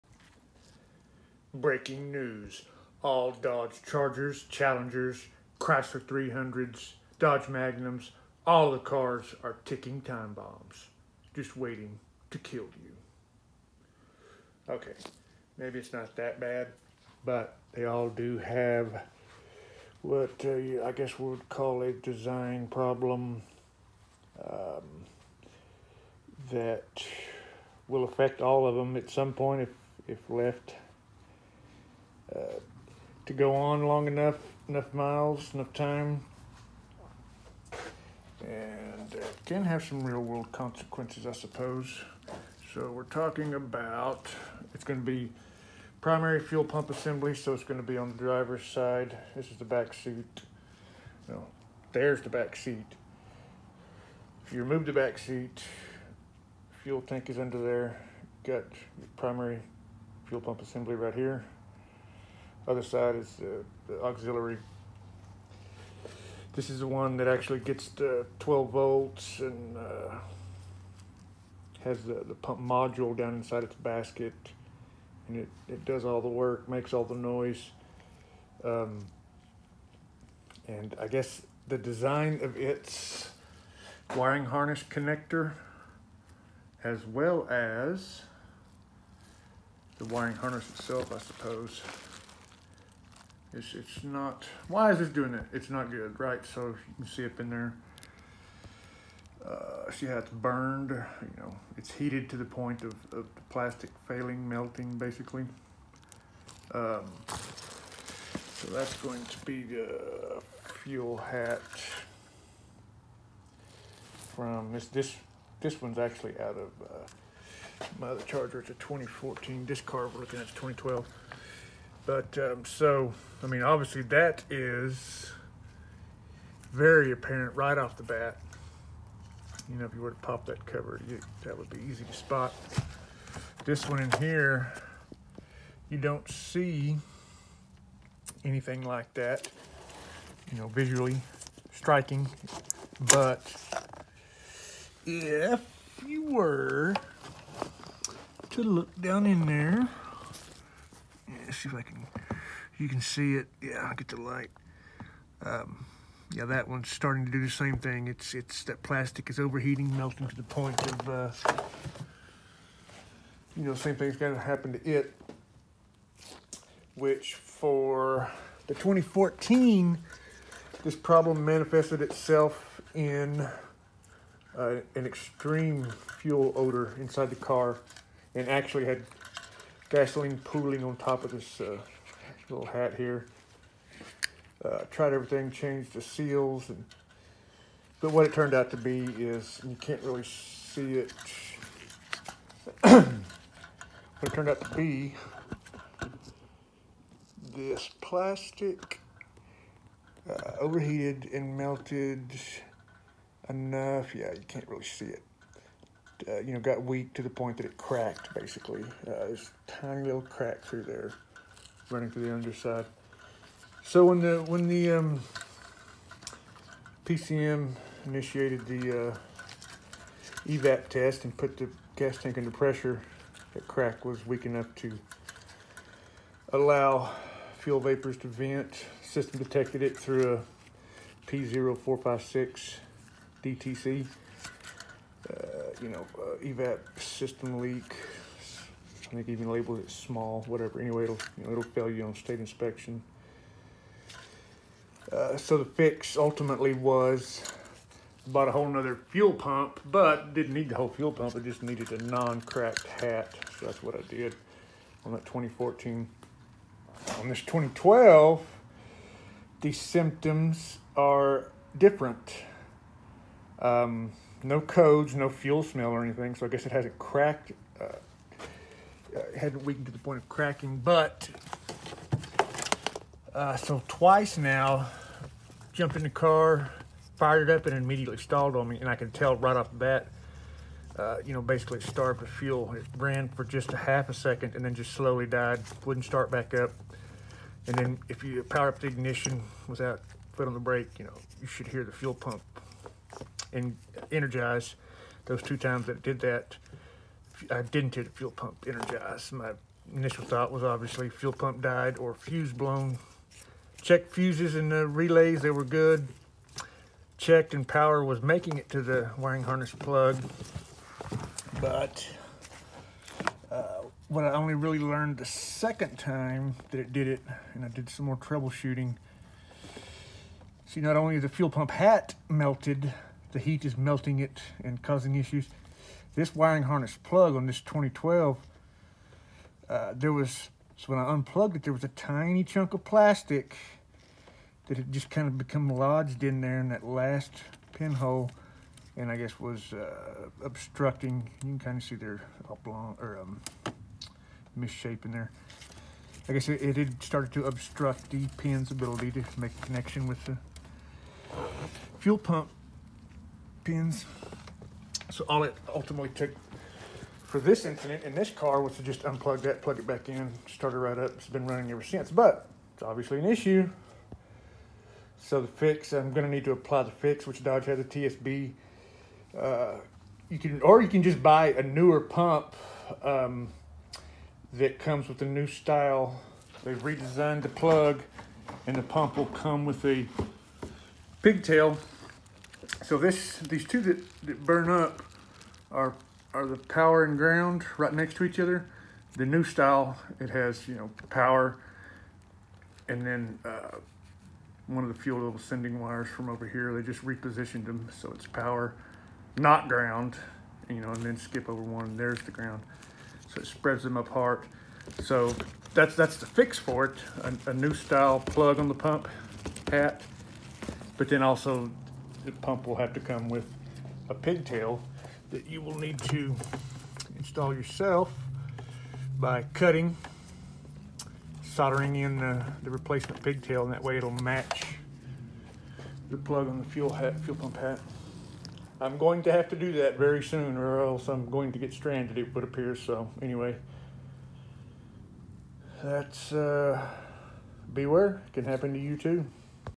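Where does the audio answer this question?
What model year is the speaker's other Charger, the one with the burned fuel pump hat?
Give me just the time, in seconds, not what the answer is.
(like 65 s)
118 s.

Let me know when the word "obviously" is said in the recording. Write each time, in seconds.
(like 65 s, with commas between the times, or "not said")
123 s, 300 s, 362 s.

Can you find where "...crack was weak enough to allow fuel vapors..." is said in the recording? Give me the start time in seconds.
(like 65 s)
223 s.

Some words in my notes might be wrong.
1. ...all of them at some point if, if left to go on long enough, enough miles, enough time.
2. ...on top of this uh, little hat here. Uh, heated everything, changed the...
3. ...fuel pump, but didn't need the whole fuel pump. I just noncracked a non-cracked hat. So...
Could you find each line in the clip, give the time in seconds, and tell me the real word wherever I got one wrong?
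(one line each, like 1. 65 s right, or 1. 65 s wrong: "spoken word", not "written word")
1. 28 s right
2. 180 s wrong: "tried", not "heated"
3. 249 s wrong: "needed", not "noncracked".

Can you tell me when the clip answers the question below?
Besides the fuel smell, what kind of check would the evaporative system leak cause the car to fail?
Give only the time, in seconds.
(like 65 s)
242 s.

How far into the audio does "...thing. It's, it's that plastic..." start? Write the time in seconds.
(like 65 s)
157 s.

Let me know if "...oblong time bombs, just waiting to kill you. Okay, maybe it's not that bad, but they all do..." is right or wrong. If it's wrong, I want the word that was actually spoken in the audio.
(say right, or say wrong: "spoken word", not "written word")
wrong: "ticking", not "oblong".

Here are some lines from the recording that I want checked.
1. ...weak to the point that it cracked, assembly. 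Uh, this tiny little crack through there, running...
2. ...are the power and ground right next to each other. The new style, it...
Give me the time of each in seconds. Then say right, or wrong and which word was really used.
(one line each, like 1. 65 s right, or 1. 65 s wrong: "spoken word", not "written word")
1. 206 s wrong: "basically", not "assembly"
2. 386 s right.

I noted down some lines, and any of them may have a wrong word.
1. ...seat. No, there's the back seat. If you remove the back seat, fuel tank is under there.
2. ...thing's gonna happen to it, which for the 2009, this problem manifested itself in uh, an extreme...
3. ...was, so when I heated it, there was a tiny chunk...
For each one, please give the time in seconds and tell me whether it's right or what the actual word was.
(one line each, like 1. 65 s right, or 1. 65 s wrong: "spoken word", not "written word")
1. 49 s right
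2. 163 s wrong: "2014", not "2009"
3. 330 s wrong: "unplugged", not "heated".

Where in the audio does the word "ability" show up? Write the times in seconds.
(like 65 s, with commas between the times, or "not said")
348 s.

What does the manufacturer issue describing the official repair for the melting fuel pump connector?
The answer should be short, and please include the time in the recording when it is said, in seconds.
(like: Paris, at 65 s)
A TSB, at 367 s.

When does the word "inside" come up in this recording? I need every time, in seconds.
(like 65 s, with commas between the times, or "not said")
73 s, 176 s.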